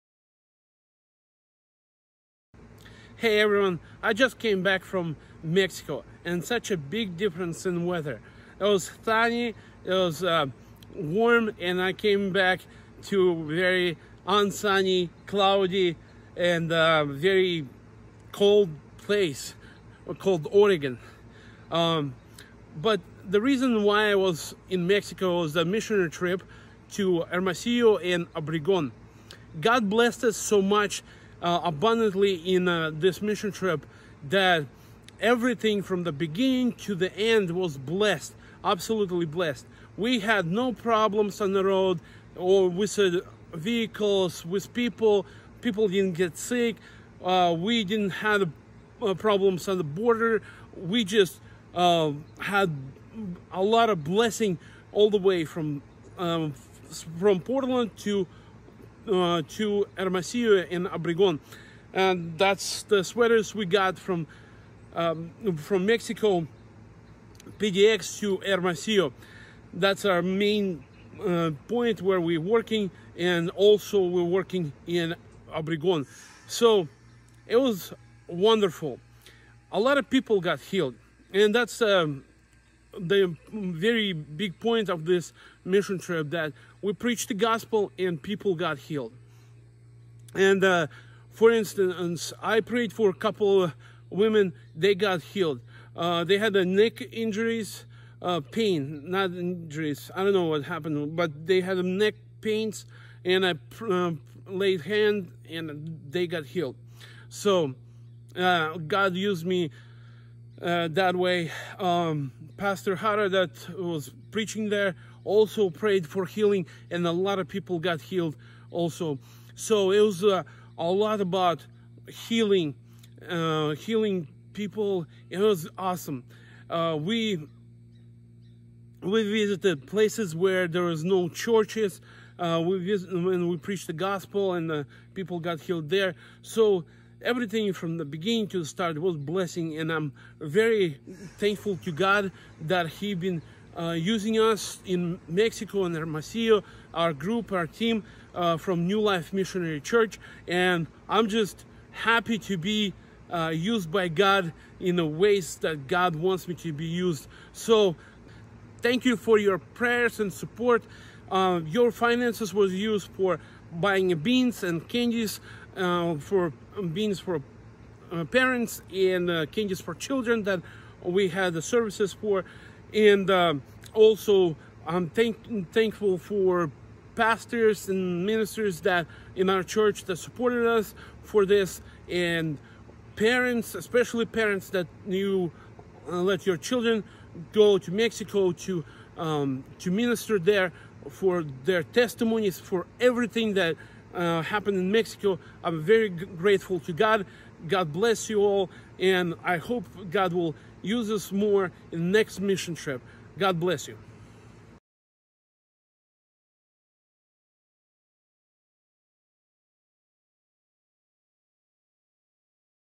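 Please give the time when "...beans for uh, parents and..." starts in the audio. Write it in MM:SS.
02:46.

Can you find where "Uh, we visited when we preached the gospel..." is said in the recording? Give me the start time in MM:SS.
02:12.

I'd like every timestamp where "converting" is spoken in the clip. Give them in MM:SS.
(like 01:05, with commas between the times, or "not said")
not said.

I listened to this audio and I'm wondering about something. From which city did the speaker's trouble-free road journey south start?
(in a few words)
Portland.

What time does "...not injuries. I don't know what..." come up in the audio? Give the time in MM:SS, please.
01:39.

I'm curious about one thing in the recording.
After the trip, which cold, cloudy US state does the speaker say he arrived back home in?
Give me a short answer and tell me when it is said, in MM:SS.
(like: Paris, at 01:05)
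Oregon, at 00:20.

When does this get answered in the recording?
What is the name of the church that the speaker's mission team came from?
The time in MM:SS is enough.
02:28.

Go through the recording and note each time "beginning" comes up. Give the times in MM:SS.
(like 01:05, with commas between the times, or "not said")
00:36, 02:18.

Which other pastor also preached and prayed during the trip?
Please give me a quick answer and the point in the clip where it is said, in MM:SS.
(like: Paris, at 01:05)
Pastor Hara, at 01:52.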